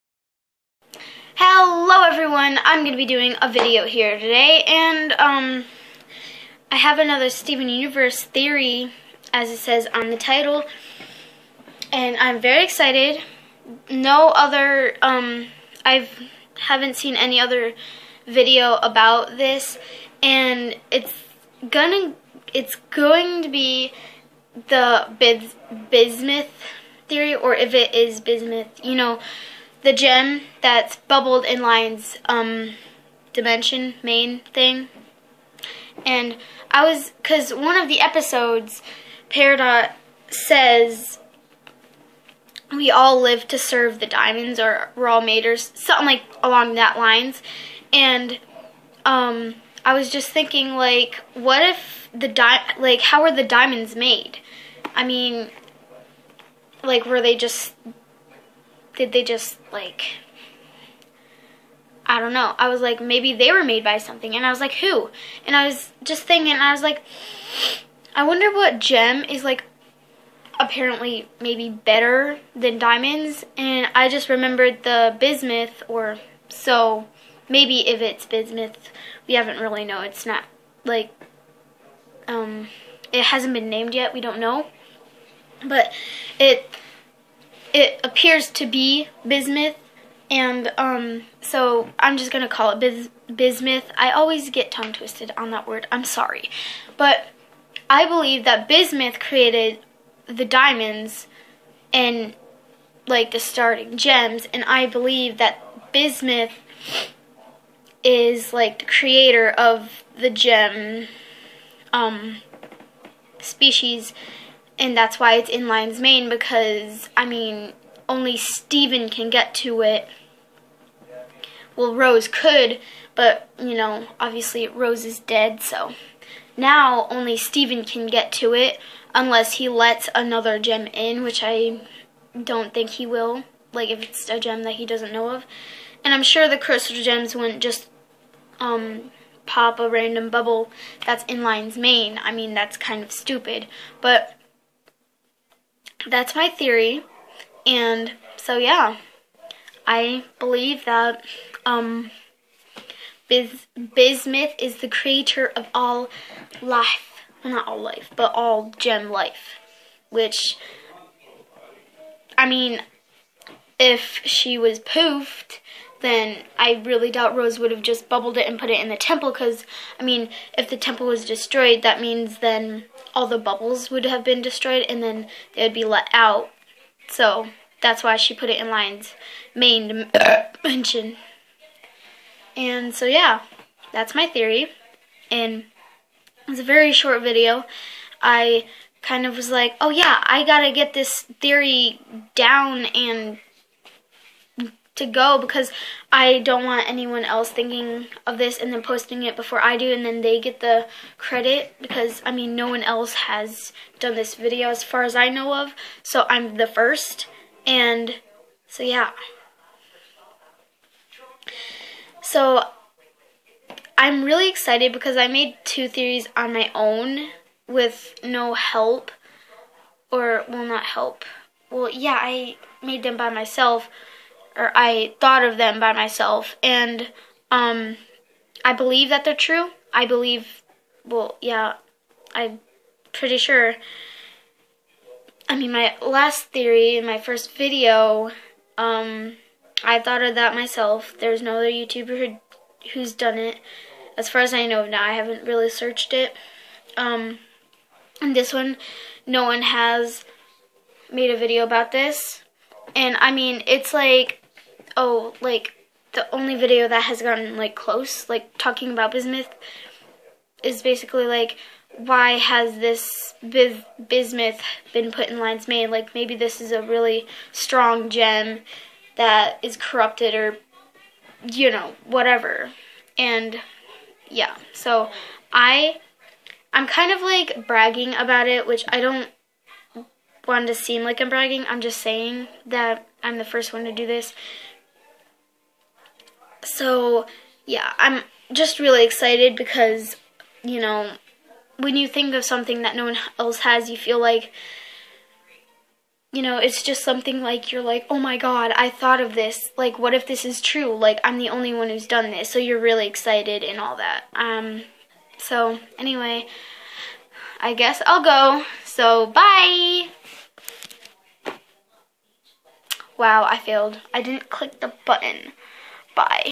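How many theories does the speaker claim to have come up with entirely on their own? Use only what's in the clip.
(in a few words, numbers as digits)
2.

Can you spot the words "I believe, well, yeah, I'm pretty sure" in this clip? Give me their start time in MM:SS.
03:49.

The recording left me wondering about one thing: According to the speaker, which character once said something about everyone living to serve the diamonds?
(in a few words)
Peridot.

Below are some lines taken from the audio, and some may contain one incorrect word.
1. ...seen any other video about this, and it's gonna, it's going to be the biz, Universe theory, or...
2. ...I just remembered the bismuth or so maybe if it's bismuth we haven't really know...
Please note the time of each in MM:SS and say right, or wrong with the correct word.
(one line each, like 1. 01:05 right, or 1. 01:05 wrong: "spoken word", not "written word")
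1. 00:16 wrong: "Bismuth", not "Universe"
2. 01:13 right.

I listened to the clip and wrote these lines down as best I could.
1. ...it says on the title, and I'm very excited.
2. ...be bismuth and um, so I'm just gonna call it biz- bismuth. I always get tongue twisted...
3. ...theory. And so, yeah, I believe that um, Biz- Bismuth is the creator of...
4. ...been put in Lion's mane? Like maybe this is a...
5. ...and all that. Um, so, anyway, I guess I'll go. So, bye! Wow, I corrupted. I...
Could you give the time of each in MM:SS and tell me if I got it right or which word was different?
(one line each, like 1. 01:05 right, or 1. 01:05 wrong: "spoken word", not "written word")
1. 00:09 right
2. 01:28 right
3. 02:26 right
4. 04:24 right
5. 05:03 wrong: "failed", not "corrupted".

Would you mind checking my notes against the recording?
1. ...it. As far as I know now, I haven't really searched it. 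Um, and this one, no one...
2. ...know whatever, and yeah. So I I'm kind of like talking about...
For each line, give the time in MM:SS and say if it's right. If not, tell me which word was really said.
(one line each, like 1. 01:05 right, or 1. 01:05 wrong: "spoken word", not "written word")
1. 04:03 right
2. 04:31 wrong: "bragging", not "talking".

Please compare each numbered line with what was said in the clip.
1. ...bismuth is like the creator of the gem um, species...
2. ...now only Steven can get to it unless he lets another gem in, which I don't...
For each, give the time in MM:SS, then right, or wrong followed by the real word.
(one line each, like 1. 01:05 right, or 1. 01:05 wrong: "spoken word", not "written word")
1. 01:45 right
2. 02:06 right.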